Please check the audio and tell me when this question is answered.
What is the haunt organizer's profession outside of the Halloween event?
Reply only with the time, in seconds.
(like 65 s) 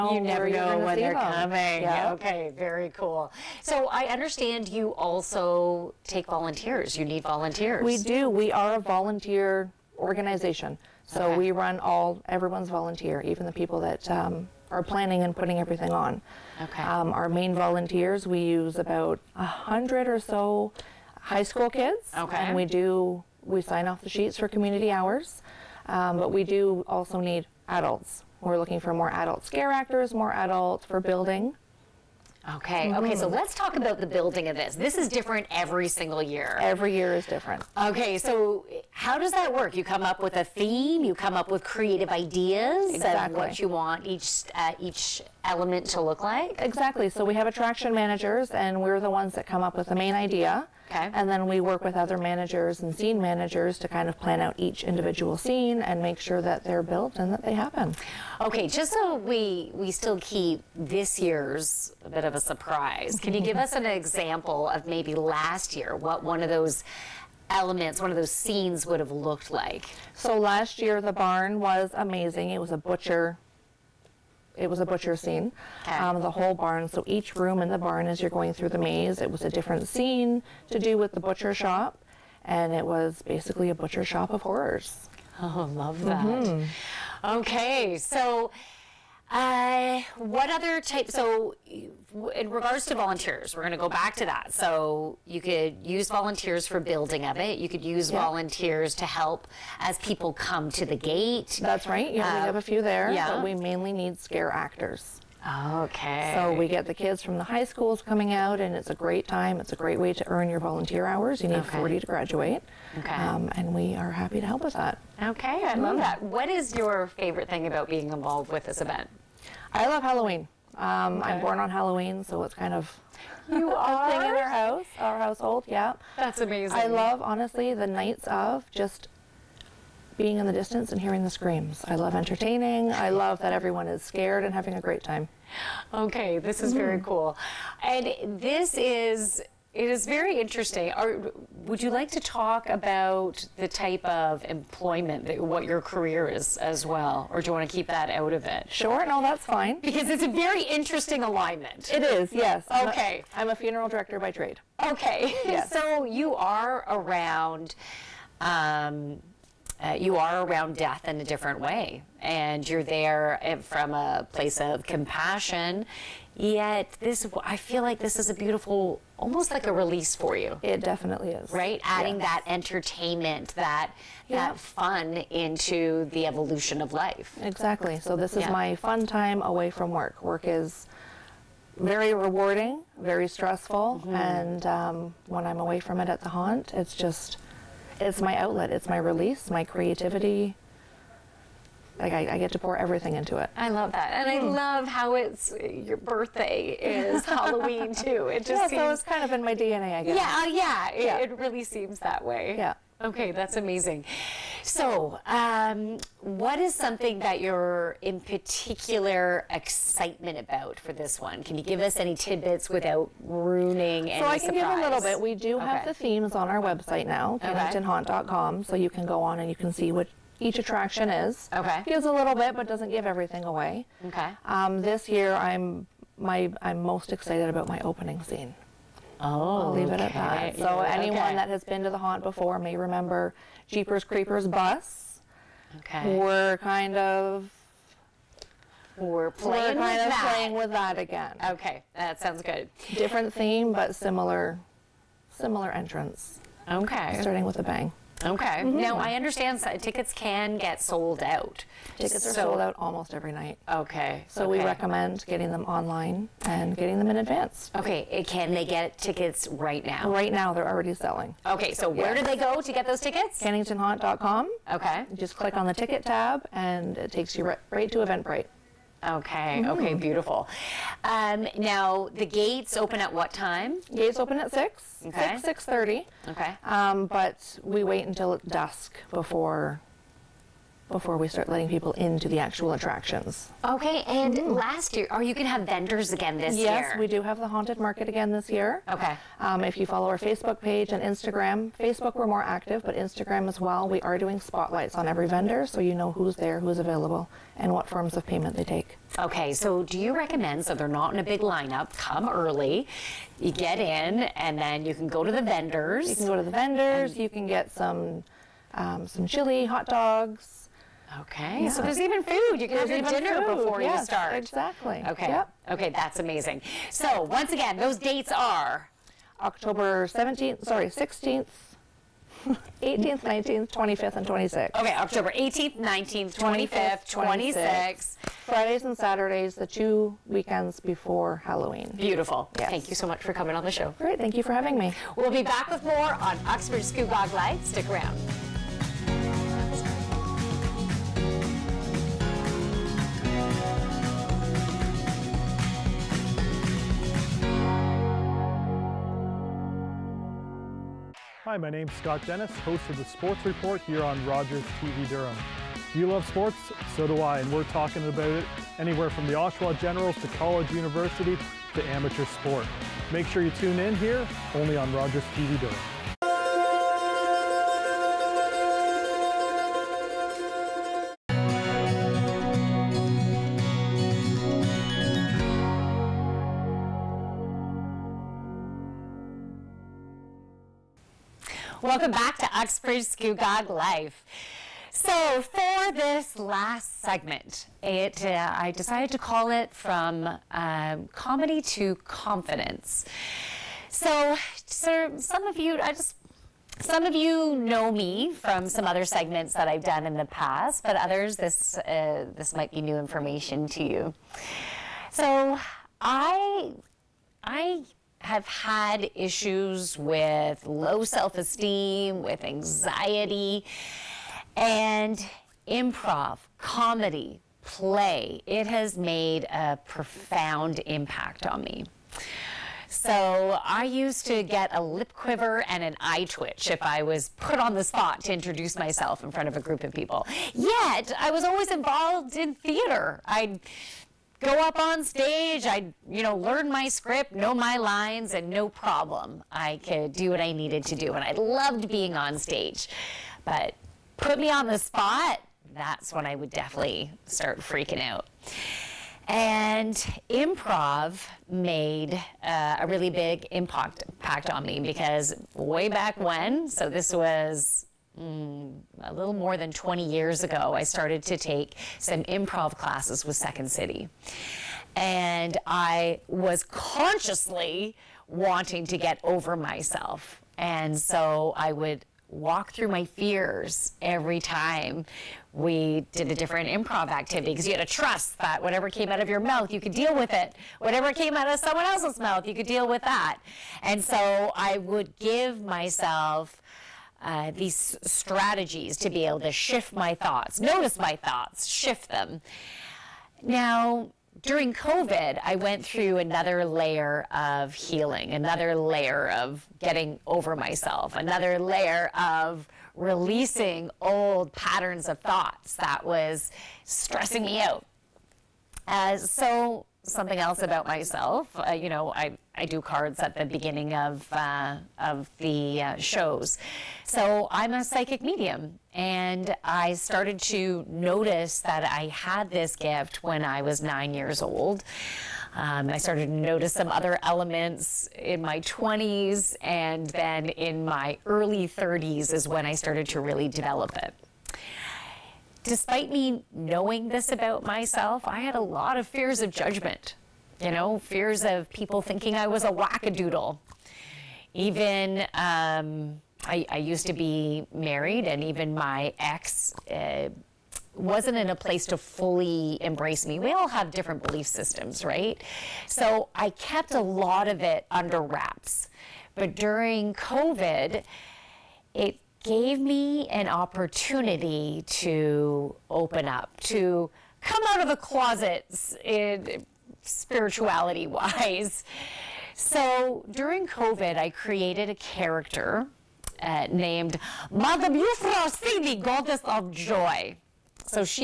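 153 s.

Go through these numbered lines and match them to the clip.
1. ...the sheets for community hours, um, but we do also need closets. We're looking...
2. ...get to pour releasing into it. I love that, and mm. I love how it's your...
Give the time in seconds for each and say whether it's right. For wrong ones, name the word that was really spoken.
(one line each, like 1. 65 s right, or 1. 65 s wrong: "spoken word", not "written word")
1. 23 s wrong: "adults", not "closets"
2. 192 s wrong: "everything", not "releasing".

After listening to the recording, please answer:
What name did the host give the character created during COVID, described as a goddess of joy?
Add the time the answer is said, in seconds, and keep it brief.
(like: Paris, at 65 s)
Madam Yufra, at 577 s.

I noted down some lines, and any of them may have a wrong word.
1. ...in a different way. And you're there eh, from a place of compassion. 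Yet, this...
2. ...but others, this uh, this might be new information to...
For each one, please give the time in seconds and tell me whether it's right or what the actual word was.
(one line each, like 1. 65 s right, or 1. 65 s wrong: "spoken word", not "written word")
1. 161 s right
2. 400 s right.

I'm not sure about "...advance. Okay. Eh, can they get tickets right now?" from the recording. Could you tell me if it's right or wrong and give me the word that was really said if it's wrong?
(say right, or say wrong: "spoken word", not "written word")
right.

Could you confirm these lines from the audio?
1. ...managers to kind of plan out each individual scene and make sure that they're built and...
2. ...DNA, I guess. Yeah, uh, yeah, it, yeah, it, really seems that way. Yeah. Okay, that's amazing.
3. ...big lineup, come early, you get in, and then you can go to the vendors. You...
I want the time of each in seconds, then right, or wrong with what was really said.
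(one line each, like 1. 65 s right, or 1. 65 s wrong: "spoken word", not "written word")
1. 53 s right
2. 199 s right
3. 301 s right.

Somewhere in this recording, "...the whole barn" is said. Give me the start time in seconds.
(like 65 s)
76 s.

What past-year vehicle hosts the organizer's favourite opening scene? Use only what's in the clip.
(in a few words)
Jeepers Creepers bus.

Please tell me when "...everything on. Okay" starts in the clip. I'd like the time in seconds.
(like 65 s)
15 s.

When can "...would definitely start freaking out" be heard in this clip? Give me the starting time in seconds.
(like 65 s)
446 s.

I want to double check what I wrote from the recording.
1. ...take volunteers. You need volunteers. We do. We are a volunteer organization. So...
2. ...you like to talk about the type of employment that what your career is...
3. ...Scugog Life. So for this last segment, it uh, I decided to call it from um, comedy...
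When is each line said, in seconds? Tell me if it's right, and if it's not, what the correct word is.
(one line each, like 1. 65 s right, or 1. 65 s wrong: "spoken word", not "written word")
1. 6 s right
2. 141 s right
3. 383 s right.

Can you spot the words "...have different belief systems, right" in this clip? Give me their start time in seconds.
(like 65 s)
553 s.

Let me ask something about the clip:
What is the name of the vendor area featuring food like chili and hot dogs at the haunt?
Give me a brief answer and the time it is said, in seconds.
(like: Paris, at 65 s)
Haunted Market, at 287 s.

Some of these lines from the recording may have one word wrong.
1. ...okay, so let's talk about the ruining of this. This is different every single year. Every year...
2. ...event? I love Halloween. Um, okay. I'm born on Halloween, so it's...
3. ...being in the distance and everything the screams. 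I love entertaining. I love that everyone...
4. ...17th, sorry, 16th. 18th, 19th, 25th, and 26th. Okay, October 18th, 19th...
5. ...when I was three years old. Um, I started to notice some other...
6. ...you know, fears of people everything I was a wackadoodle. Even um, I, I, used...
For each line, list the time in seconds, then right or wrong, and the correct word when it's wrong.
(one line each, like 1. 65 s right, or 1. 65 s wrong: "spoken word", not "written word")
1. 32 s wrong: "building", not "ruining"
2. 118 s right
3. 130 s wrong: "hearing", not "everything"
4. 320 s right
5. 523 s wrong: "nine", not "three"
6. 540 s wrong: "thinking", not "everything".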